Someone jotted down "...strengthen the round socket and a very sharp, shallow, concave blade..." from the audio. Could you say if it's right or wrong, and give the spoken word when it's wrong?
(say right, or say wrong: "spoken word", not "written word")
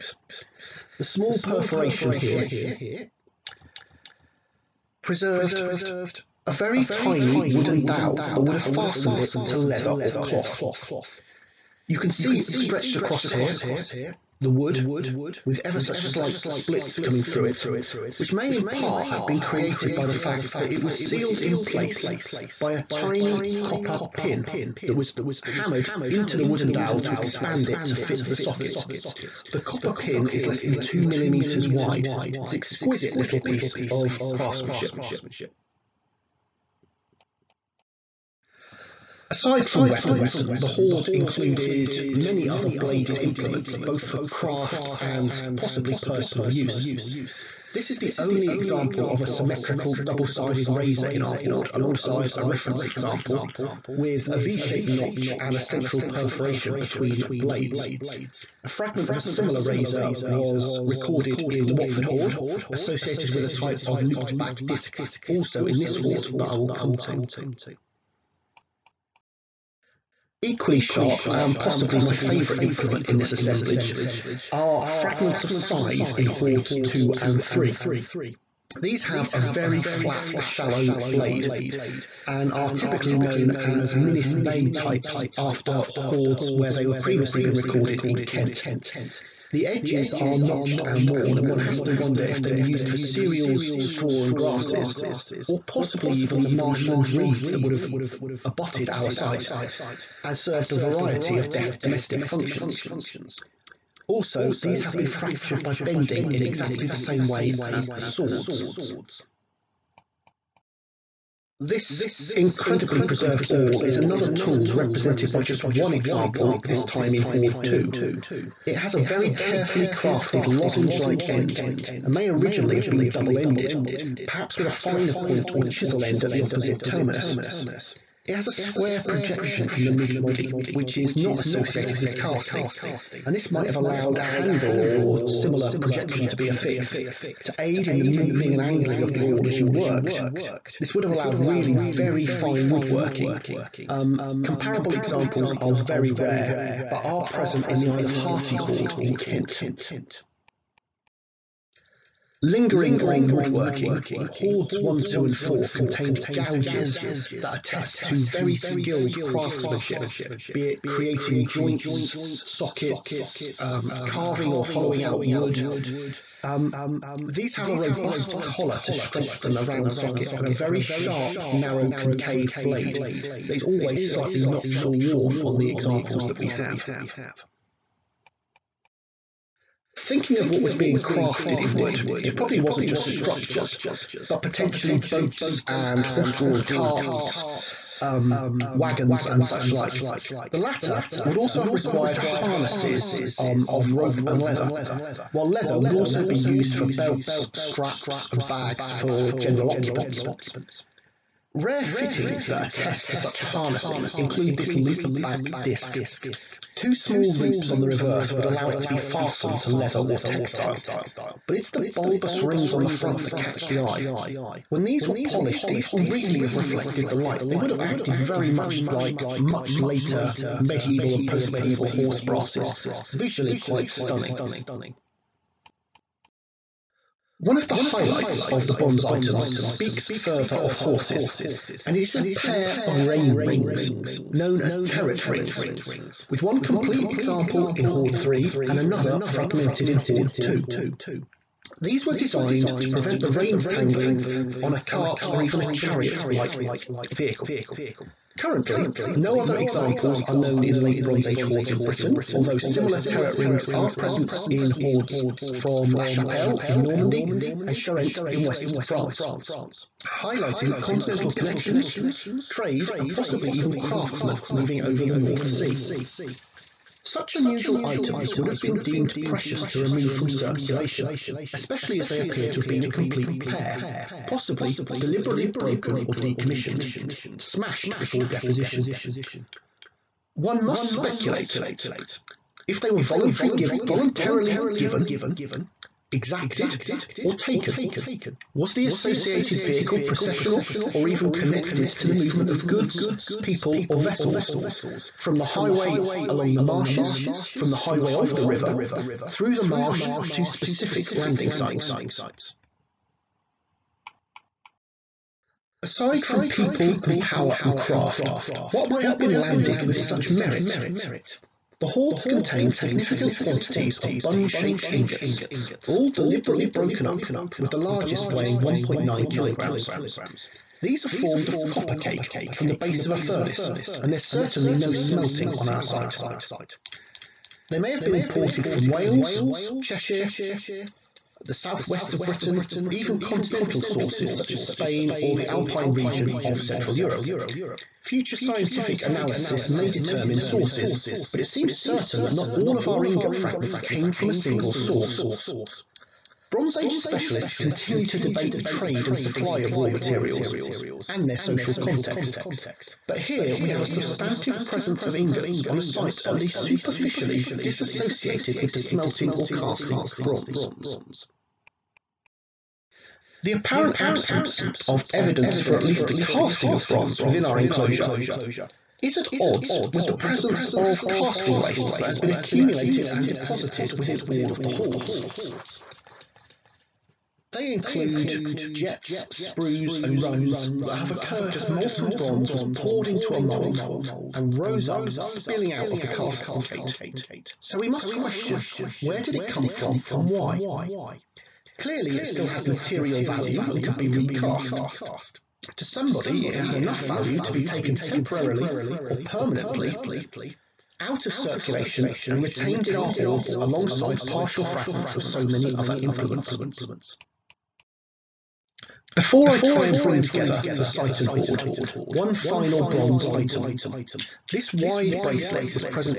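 wrong: "narrow", not "shallow".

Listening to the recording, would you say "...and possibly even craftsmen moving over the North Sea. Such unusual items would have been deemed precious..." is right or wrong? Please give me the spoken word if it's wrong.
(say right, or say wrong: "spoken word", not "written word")
right.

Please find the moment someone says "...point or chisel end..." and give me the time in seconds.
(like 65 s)
125 s.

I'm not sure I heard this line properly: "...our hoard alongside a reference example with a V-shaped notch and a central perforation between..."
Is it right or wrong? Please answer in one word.
right.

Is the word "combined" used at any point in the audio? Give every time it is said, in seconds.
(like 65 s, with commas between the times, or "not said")
not said.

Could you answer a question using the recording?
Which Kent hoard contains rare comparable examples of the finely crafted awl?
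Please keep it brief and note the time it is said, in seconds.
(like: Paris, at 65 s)
Isle of Harty hoard, at 147 s.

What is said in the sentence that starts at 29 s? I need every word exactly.
The copper pin is less than 2 millimeters wide.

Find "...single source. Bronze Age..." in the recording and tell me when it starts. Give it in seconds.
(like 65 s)
344 s.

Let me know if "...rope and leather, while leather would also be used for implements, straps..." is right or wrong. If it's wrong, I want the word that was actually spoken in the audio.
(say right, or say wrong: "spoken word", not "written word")
wrong: "belts", not "implements".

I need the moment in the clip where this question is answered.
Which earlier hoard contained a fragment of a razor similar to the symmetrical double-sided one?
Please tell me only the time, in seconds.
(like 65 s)
61 s.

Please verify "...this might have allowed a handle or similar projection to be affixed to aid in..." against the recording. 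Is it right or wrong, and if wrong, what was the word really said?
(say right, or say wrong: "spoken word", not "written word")
right.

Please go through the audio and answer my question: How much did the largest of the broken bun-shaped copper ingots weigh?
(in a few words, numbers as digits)
1.9 kilograms.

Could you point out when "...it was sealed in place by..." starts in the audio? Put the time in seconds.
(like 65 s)
20 s.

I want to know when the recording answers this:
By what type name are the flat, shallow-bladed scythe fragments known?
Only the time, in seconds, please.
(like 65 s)
83 s.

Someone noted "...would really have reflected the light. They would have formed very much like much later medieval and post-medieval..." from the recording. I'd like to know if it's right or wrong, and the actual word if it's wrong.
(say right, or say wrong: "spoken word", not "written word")
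wrong: "acted", not "formed".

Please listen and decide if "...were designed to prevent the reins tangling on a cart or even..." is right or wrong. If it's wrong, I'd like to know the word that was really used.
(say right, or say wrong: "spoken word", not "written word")
right.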